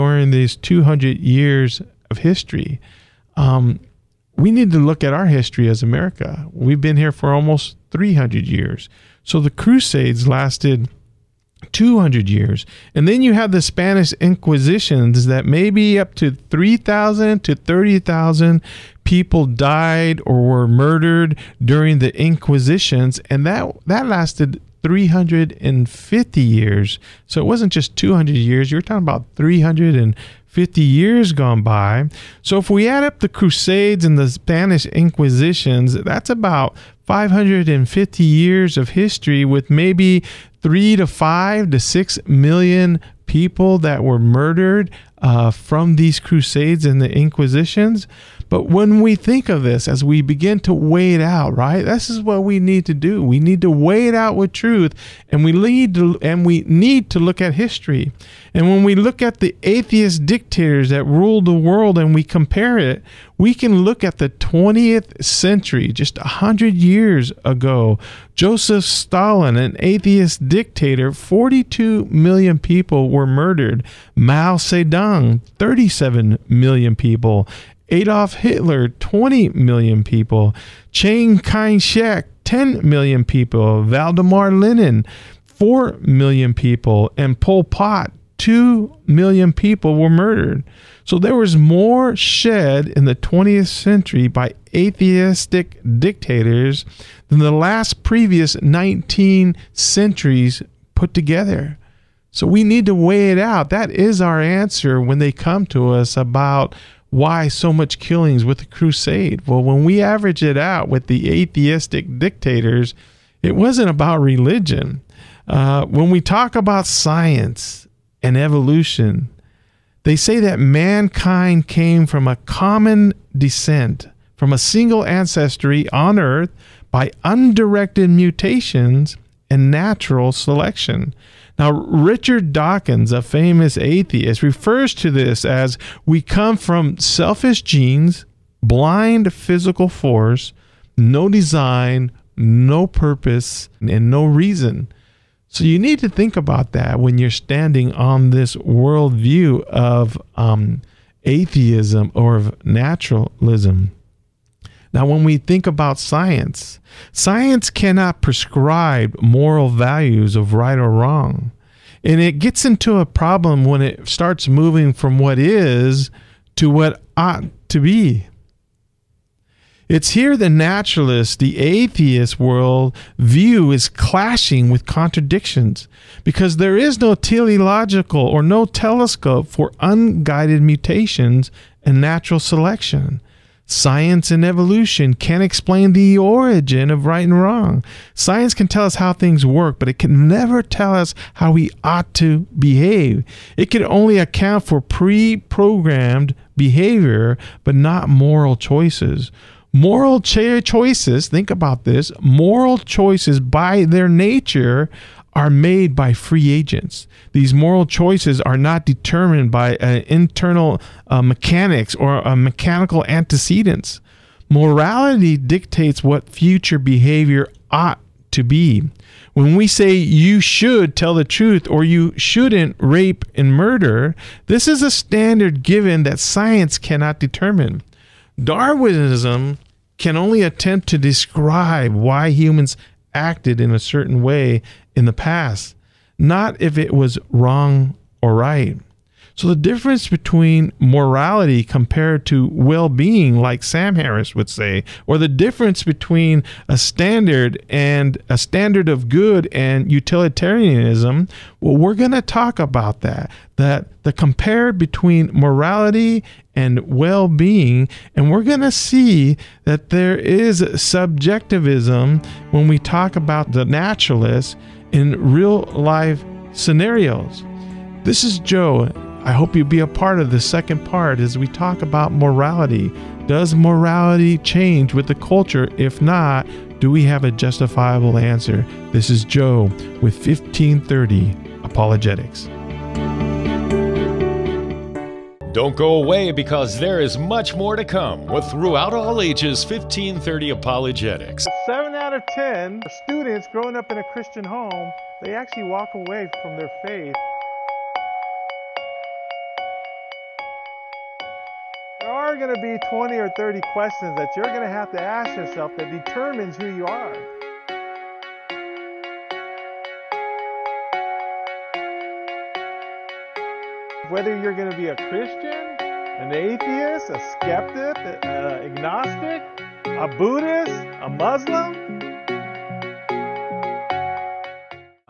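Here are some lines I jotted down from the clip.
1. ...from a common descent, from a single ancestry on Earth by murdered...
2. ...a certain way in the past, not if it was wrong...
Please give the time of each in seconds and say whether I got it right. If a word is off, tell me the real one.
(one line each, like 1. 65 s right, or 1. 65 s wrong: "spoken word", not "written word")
1. 122 s wrong: "undirected", not "murdered"
2. 233 s right.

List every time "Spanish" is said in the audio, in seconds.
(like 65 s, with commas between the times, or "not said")
13 s, 34 s.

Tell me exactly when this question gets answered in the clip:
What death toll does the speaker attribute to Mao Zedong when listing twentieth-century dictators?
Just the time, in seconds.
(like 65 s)
75 s.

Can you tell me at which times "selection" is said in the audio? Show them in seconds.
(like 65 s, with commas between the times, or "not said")
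130 s, 182 s.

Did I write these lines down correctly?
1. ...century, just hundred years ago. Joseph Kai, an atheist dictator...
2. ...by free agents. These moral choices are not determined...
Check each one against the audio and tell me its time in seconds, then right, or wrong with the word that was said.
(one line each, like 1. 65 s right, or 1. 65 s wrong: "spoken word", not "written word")
1. 65 s wrong: "Stalin", not "Kai"
2. 205 s right.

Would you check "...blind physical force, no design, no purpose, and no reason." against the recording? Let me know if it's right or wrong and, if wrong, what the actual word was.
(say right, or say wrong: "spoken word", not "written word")
right.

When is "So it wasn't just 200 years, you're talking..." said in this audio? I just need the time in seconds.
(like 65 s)
27 s.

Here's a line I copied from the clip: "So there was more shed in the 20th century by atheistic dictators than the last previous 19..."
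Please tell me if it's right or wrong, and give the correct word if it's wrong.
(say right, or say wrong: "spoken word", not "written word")
right.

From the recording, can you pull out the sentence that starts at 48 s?
But when we think of this, as we begin to weigh it out, right?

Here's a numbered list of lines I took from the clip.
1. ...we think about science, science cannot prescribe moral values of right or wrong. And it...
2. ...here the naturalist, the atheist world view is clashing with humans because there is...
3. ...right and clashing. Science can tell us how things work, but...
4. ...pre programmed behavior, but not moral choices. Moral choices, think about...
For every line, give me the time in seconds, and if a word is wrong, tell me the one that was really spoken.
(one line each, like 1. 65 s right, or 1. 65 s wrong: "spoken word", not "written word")
1. 155 s right
2. 170 s wrong: "contradictions", not "humans"
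3. 187 s wrong: "wrong", not "clashing"
4. 194 s right.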